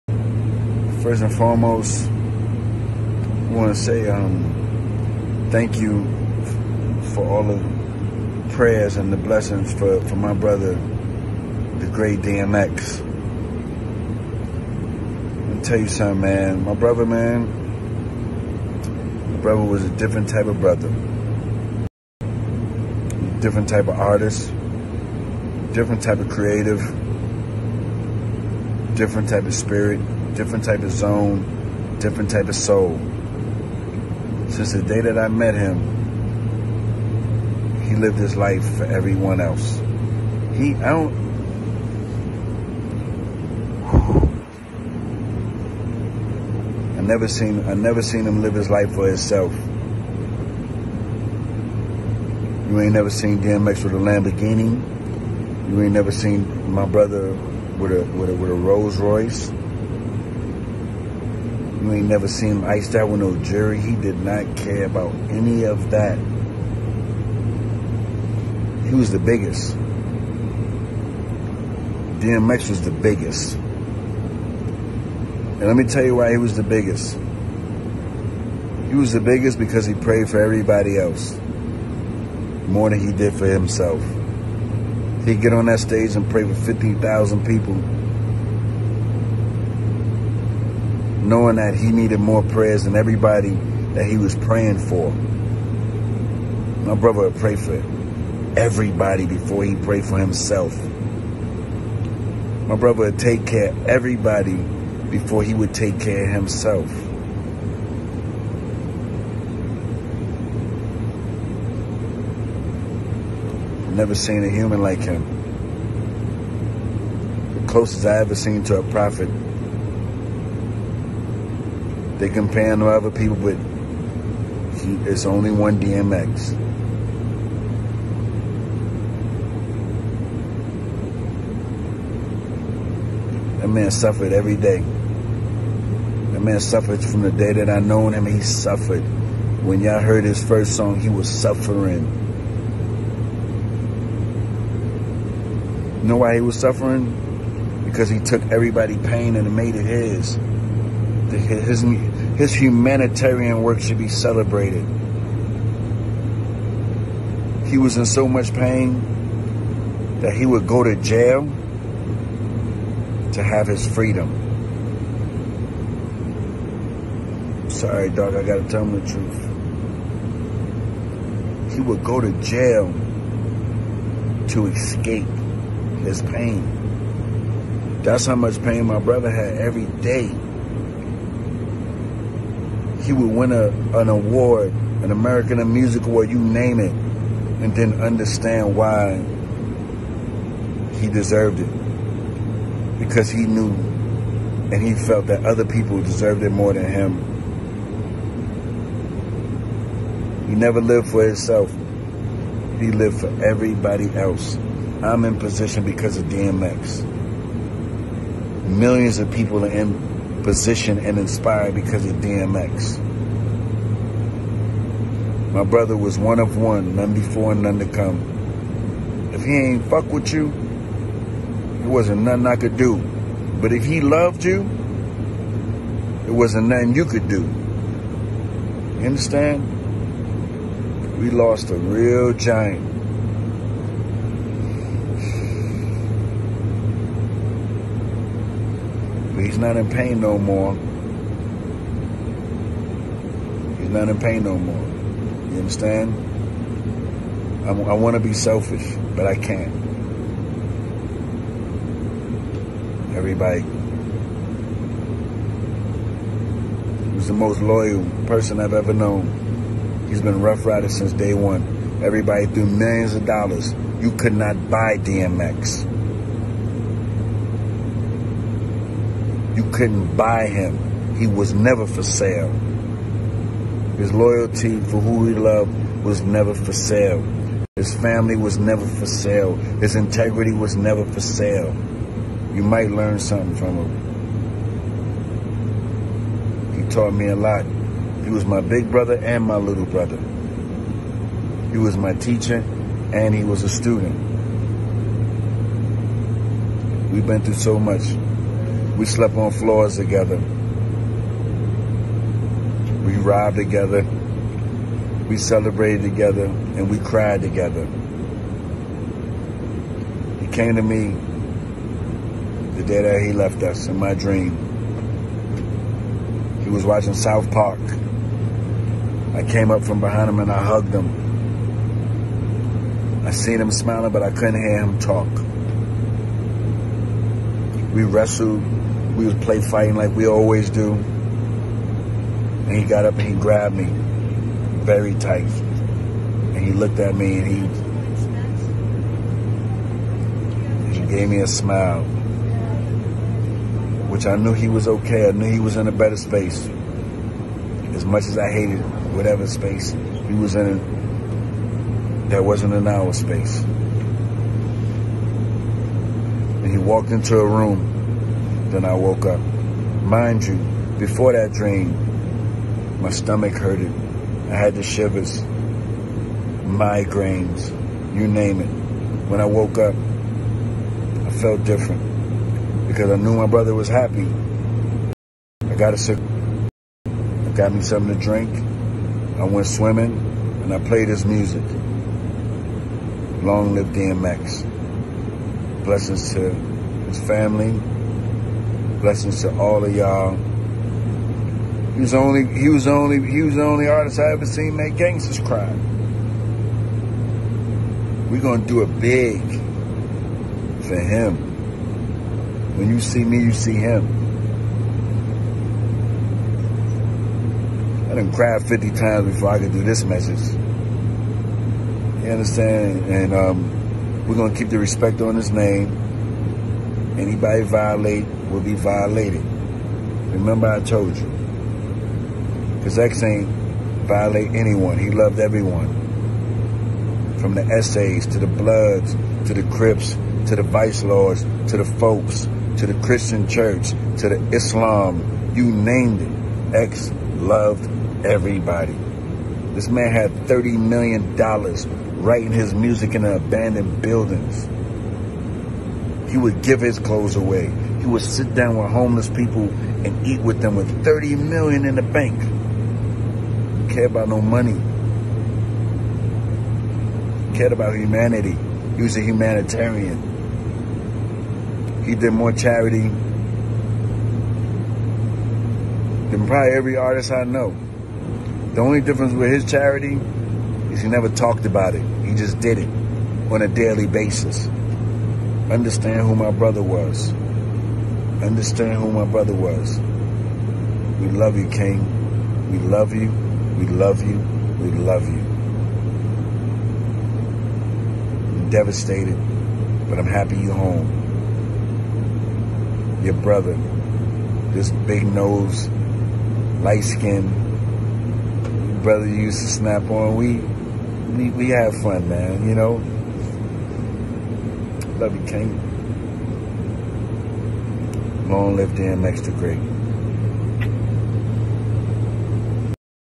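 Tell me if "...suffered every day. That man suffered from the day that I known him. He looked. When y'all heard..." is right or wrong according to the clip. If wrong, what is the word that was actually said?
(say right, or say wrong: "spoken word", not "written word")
wrong: "suffered", not "looked".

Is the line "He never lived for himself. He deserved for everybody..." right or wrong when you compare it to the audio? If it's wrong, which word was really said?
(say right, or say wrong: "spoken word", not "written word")
wrong: "lived", not "deserved".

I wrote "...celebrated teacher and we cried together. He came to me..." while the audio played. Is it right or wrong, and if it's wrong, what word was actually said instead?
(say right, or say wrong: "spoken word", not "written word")
wrong: "together", not "teacher".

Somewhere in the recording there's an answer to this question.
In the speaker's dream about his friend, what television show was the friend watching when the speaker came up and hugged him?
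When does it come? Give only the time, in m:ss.
5:17.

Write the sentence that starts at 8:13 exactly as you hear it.
Your brother, this big nose, light skin, brother used to snap on weed we, we have fun, man, you know.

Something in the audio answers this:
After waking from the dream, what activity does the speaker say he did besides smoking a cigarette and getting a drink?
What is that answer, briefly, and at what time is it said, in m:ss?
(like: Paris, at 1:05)
swimming, at 6:19.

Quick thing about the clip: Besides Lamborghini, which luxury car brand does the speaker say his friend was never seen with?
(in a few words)
Rolls Royce.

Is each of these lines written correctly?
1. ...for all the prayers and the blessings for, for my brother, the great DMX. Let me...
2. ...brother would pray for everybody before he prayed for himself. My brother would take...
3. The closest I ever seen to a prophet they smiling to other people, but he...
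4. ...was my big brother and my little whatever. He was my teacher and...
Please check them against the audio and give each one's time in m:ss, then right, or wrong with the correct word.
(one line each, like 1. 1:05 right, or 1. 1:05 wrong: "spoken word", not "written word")
1. 0:07 right
2. 1:36 right
3. 1:57 wrong: "comparing", not "smiling"
4. 4:48 wrong: "brother", not "whatever".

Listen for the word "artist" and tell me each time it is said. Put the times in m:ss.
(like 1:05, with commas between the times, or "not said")
0:23, 6:33, 7:46.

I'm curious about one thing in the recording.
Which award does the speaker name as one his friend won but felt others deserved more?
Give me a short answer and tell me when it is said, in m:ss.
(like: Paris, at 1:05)
American Music Award, at 3:05.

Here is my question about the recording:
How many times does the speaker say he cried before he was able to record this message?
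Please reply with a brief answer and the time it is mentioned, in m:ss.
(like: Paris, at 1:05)
50, at 6:48.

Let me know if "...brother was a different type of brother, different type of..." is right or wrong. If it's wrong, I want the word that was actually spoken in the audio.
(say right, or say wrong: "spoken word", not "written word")
right.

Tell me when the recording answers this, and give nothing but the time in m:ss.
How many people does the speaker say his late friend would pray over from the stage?
1:26.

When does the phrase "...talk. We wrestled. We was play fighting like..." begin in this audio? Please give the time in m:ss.
5:24.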